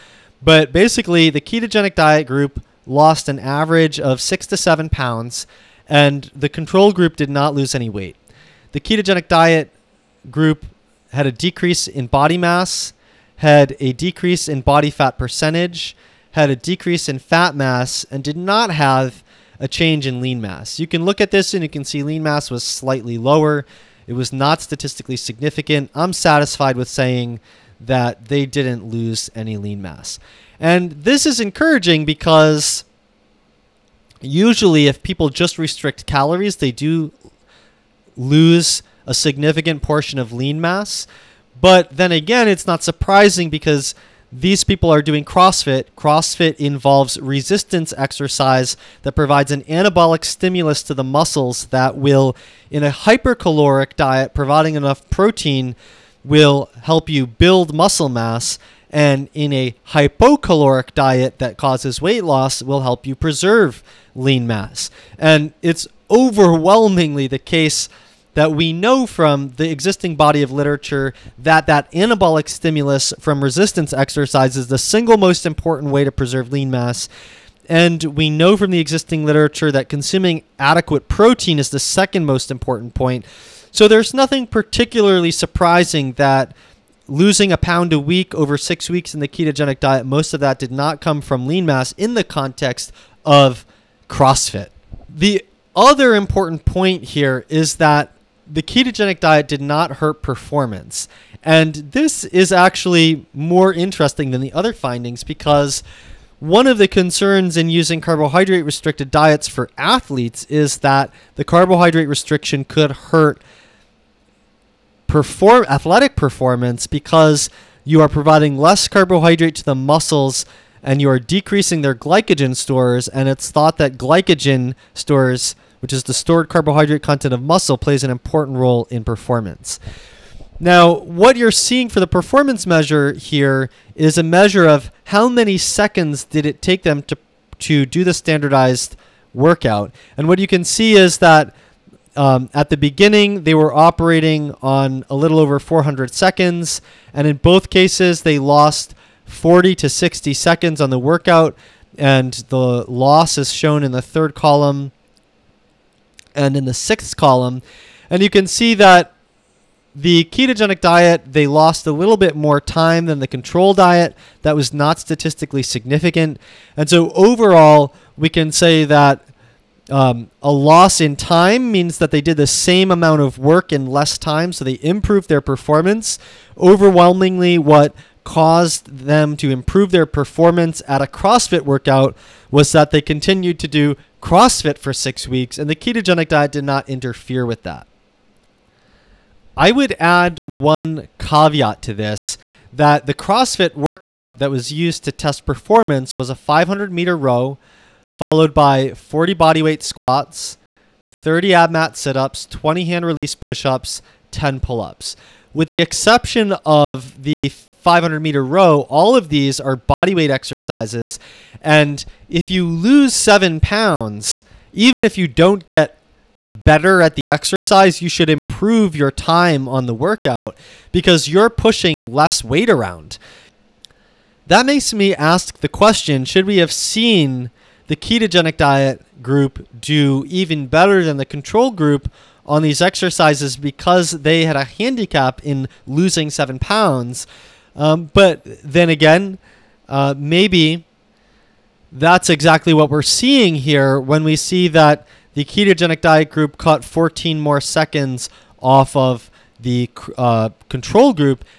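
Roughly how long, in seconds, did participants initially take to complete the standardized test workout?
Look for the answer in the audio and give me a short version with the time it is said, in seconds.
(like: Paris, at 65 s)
a little over 400 seconds, at 145 s.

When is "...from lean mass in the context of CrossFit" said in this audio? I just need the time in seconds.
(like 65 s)
91 s.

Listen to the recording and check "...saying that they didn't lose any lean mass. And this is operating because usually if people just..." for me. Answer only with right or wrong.
wrong.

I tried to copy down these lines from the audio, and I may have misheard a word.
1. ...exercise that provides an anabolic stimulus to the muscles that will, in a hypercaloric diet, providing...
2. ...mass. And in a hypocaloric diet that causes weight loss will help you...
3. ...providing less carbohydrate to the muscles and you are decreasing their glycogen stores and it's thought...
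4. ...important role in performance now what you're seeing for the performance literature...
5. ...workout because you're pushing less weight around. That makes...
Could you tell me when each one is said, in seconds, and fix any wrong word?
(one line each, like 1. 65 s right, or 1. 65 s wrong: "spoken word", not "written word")
1. 47 s right
2. 58 s right
3. 118 s right
4. 128 s wrong: "measure", not "literature"
5. 219 s right.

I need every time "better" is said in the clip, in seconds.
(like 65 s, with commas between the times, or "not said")
216 s, 230 s.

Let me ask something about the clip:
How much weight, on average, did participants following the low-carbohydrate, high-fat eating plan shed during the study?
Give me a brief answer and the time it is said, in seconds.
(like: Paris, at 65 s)
6 to 7 pounds, at 4 s.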